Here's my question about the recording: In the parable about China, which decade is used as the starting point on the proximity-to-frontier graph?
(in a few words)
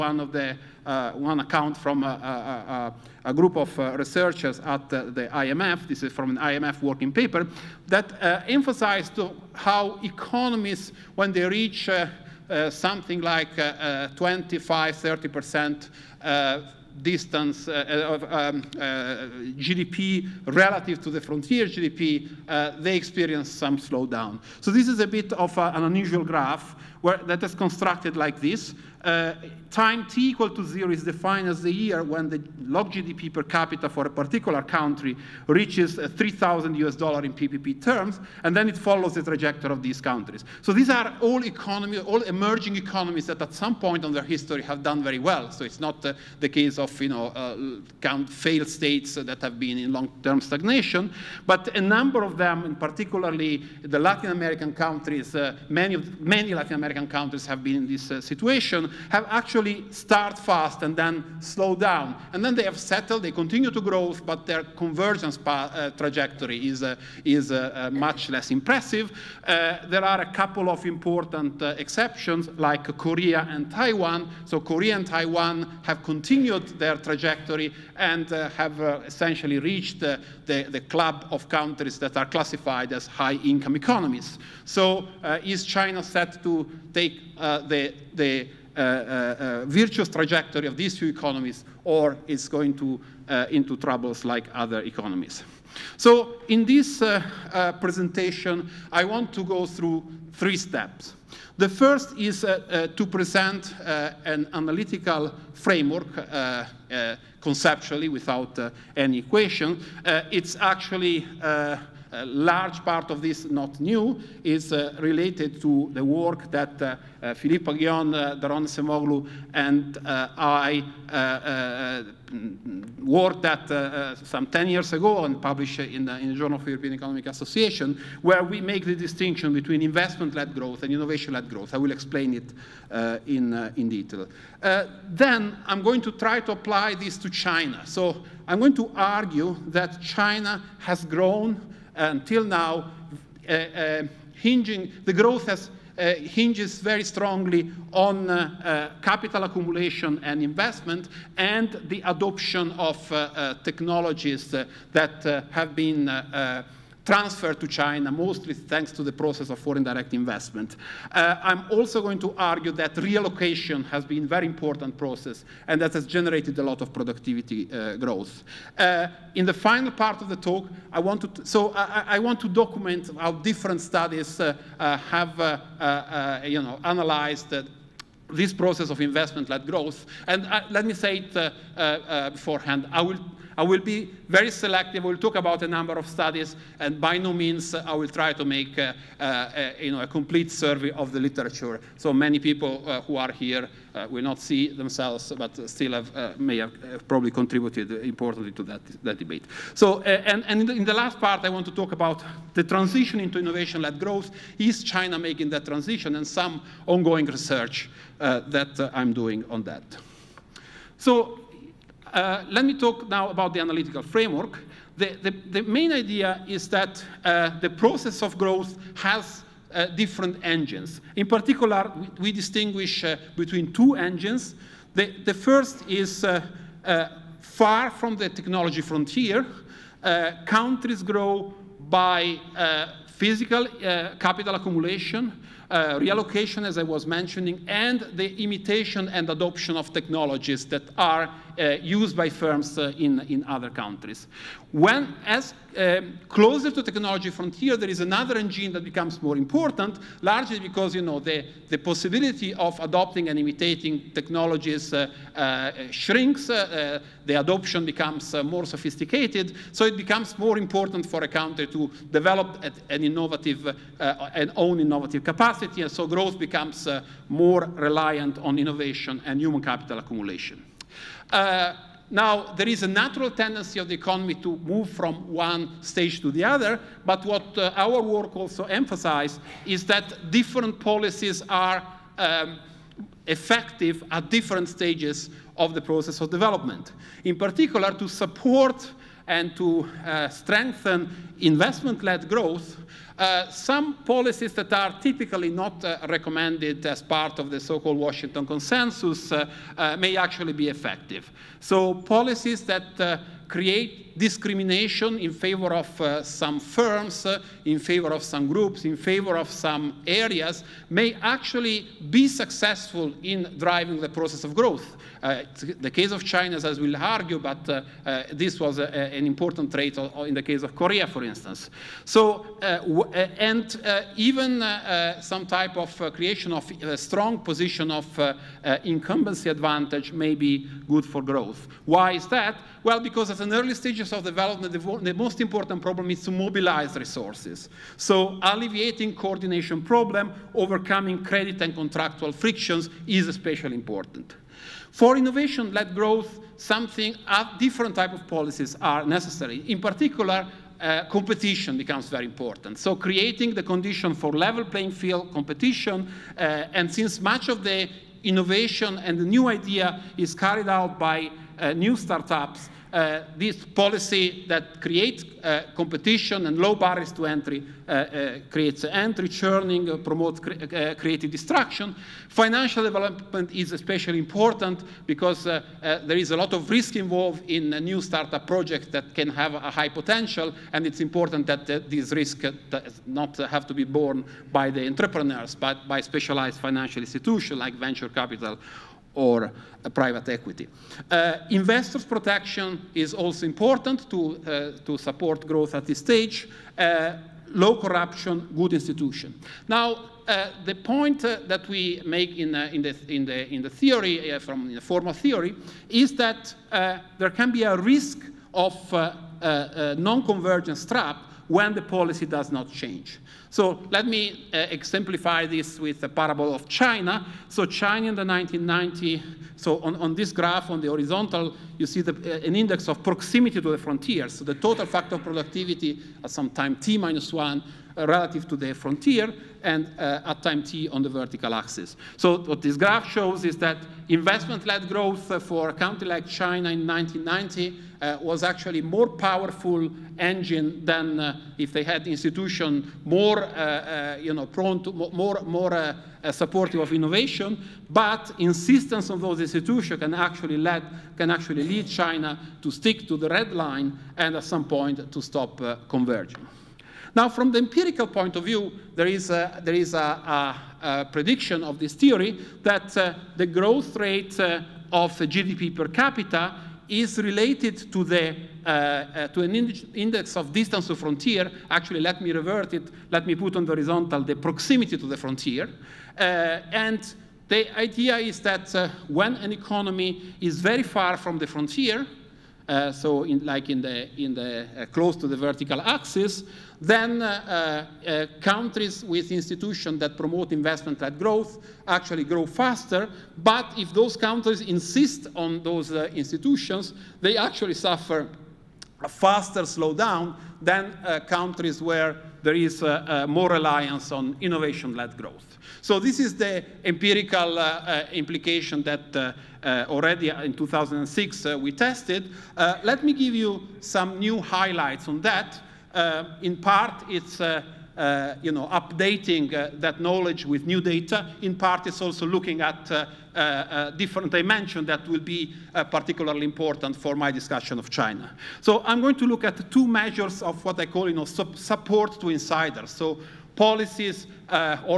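1990s.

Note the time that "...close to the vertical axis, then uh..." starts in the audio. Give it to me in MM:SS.
08:04.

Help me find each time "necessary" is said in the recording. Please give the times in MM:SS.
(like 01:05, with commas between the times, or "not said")
05:49.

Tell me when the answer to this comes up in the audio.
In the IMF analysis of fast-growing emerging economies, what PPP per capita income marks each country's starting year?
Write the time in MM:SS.
00:36.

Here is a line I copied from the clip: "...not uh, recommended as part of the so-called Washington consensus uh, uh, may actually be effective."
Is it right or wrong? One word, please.
right.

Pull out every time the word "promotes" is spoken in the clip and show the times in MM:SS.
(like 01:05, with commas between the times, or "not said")
06:09, 08:10.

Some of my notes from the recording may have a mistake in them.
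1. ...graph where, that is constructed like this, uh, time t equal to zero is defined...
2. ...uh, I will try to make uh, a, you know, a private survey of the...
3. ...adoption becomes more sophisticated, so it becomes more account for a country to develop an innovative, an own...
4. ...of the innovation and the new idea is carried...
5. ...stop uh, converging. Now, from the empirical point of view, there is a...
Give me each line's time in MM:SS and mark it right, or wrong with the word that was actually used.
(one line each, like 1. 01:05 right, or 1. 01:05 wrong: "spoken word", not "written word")
1. 00:26 right
2. 03:07 wrong: "complete", not "private"
3. 04:17 wrong: "important", not "account"
4. 05:57 right
5. 07:35 right.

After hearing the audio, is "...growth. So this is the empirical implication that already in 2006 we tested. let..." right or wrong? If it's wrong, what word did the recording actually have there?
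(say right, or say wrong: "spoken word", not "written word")
right.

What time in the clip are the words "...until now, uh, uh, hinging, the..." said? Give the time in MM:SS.
02:22.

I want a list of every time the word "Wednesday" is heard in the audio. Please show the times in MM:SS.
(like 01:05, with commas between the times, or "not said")
not said.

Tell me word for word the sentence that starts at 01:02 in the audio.
And then they have settled, they continue to grow, but their convergence uh, trajectory is, uh, is uh, uh much less impressive.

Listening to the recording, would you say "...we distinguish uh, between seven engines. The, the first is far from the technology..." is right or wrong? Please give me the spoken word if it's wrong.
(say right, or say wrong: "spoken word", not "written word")
wrong: "two", not "seven".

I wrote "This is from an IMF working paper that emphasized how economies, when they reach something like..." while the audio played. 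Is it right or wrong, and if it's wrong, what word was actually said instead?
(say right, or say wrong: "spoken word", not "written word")
right.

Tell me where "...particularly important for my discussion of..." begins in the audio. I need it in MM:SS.
08:45.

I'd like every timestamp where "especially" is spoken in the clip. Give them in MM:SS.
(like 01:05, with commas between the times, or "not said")
05:43, 06:13.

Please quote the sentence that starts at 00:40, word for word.
So these are all economy, all emerging economies that at some point in their history have done very well.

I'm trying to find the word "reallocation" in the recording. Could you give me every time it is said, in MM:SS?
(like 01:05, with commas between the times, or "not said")
02:42, 03:55.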